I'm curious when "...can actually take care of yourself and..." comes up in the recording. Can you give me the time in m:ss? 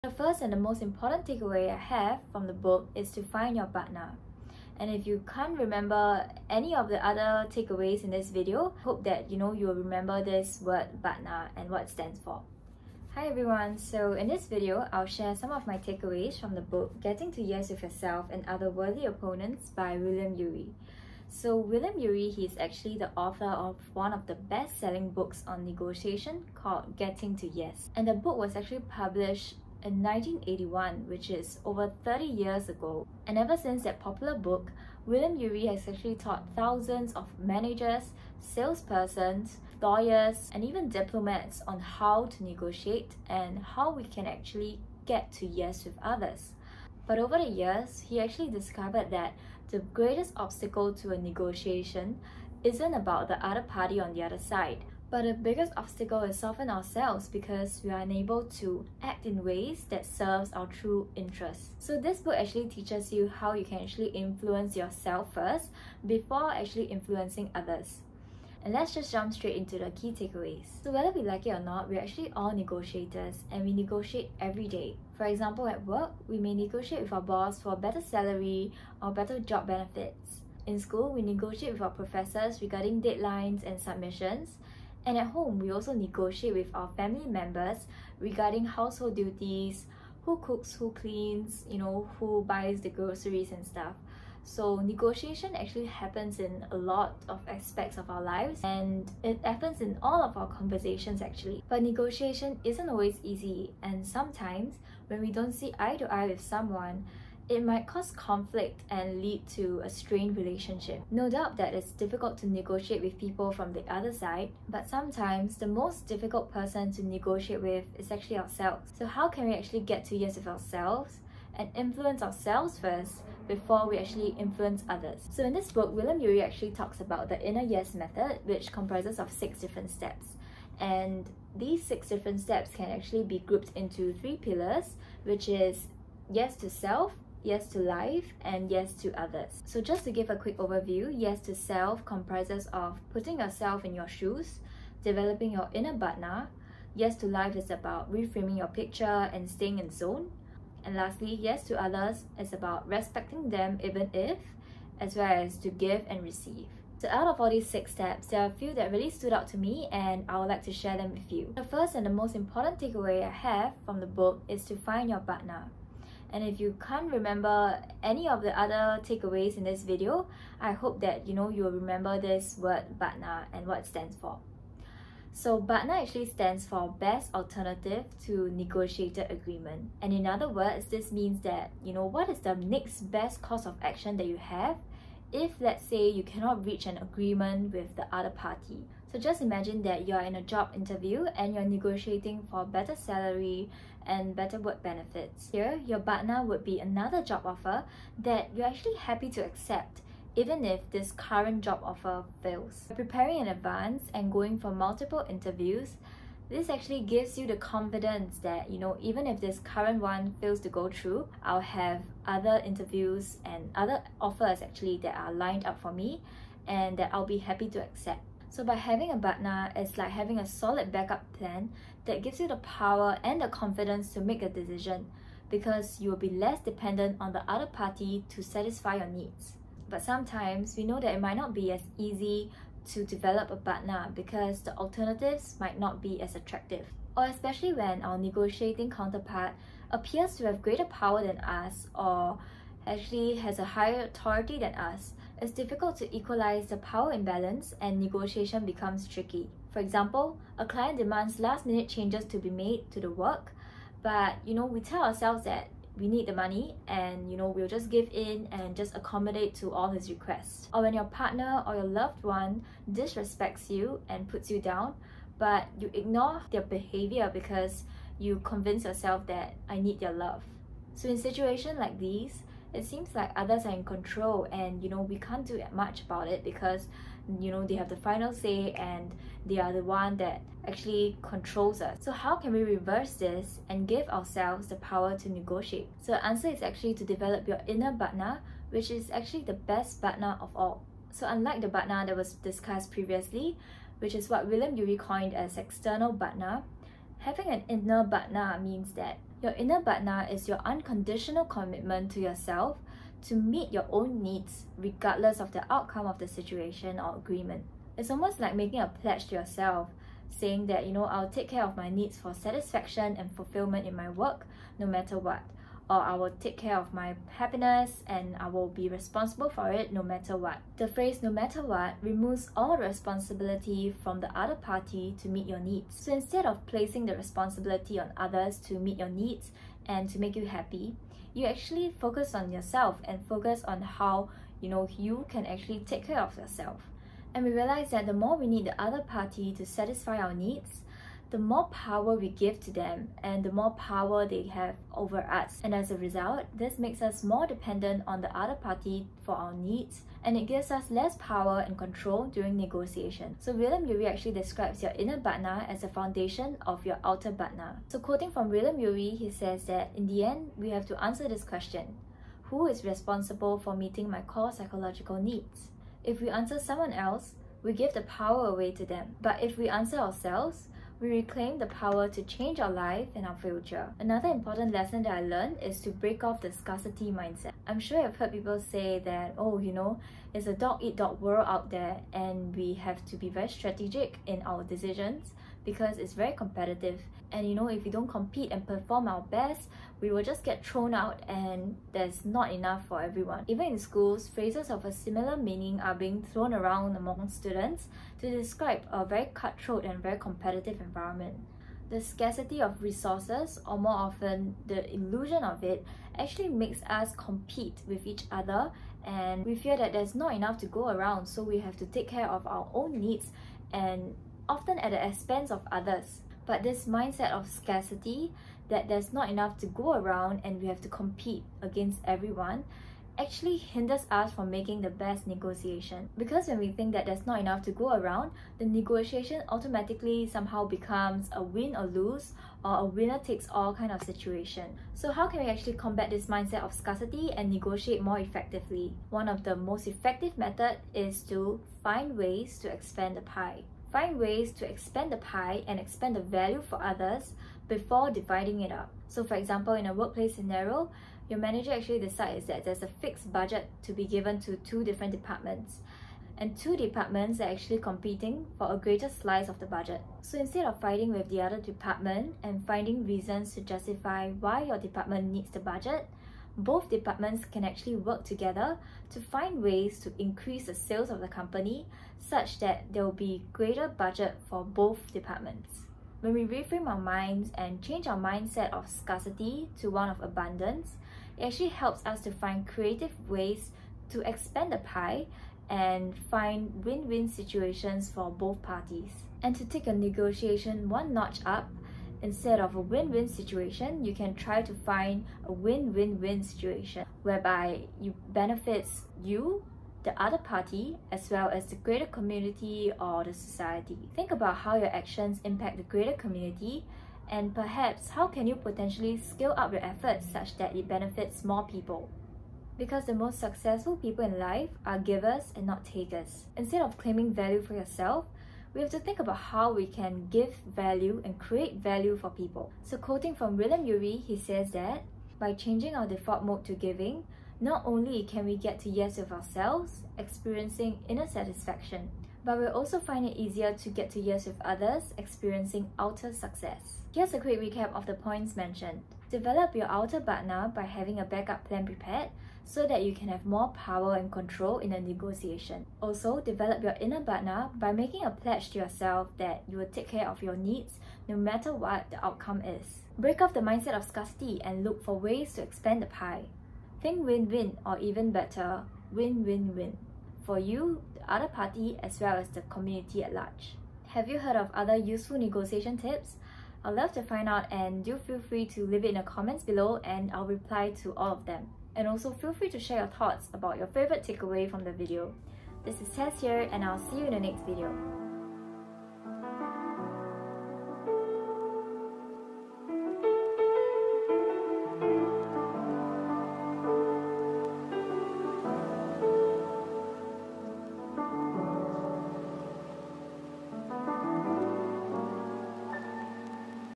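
5:35.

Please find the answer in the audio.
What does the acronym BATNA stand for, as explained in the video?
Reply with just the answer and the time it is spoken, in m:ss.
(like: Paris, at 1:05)
Best Alternative to Negotiated Agreement, at 2:56.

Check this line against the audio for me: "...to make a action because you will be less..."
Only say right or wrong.
wrong.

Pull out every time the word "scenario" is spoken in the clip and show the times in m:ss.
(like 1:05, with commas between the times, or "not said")
7:30.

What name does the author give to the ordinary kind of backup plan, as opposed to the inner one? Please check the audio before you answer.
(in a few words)
external BATNA.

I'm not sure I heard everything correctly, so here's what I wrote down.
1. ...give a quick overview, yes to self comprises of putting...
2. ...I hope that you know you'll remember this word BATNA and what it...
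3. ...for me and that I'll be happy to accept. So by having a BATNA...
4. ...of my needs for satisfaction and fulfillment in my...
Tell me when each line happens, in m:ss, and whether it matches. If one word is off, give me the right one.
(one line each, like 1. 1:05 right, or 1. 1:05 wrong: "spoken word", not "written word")
1. 2:20 right
2. 2:50 right
3. 3:35 right
4. 5:11 right.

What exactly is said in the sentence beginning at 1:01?
So this book actually teaches you how you can actually influence yourself first before actually influencing others.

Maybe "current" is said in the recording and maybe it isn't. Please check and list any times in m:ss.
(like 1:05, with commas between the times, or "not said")
3:21, 3:29.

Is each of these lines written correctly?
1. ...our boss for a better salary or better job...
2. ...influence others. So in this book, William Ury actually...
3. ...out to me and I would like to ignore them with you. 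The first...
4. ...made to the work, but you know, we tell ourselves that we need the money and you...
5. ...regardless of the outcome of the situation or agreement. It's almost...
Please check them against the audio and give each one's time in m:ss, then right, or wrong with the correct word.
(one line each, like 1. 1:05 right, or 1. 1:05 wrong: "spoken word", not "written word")
1. 1:17 right
2. 2:04 right
3. 2:39 wrong: "share", not "ignore"
4. 4:12 right
5. 5:04 right.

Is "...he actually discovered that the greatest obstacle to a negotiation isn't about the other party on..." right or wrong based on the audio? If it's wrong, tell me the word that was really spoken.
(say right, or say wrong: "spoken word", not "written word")
right.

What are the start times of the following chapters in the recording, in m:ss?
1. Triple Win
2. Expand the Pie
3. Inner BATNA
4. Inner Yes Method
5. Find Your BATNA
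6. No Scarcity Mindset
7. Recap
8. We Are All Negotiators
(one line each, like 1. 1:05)
1. 8:13
2. 7:22
3. 4:50
4. 2:04
5. 2:43
6. 6:16
7. 8:56
8. 1:10.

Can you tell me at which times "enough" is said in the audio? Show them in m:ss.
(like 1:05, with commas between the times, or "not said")
6:32, 6:50, 6:59, 7:07.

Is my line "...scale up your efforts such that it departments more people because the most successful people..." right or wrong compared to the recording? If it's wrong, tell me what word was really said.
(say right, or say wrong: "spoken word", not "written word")
wrong: "benefits", not "departments".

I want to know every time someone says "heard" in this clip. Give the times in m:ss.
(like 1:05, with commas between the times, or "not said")
6:18, 9:24.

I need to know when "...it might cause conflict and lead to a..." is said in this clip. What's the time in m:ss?
1:47.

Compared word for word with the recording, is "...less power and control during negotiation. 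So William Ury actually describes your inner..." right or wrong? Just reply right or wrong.
right.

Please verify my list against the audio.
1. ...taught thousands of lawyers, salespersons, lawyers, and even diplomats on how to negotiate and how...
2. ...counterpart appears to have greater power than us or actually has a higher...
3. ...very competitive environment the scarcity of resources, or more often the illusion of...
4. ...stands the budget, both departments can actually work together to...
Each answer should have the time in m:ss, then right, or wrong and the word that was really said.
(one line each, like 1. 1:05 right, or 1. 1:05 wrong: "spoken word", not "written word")
1. 0:36 wrong: "managers", not "lawyers"
2. 3:58 right
3. 6:40 right
4. 7:45 wrong: "needs", not "stands".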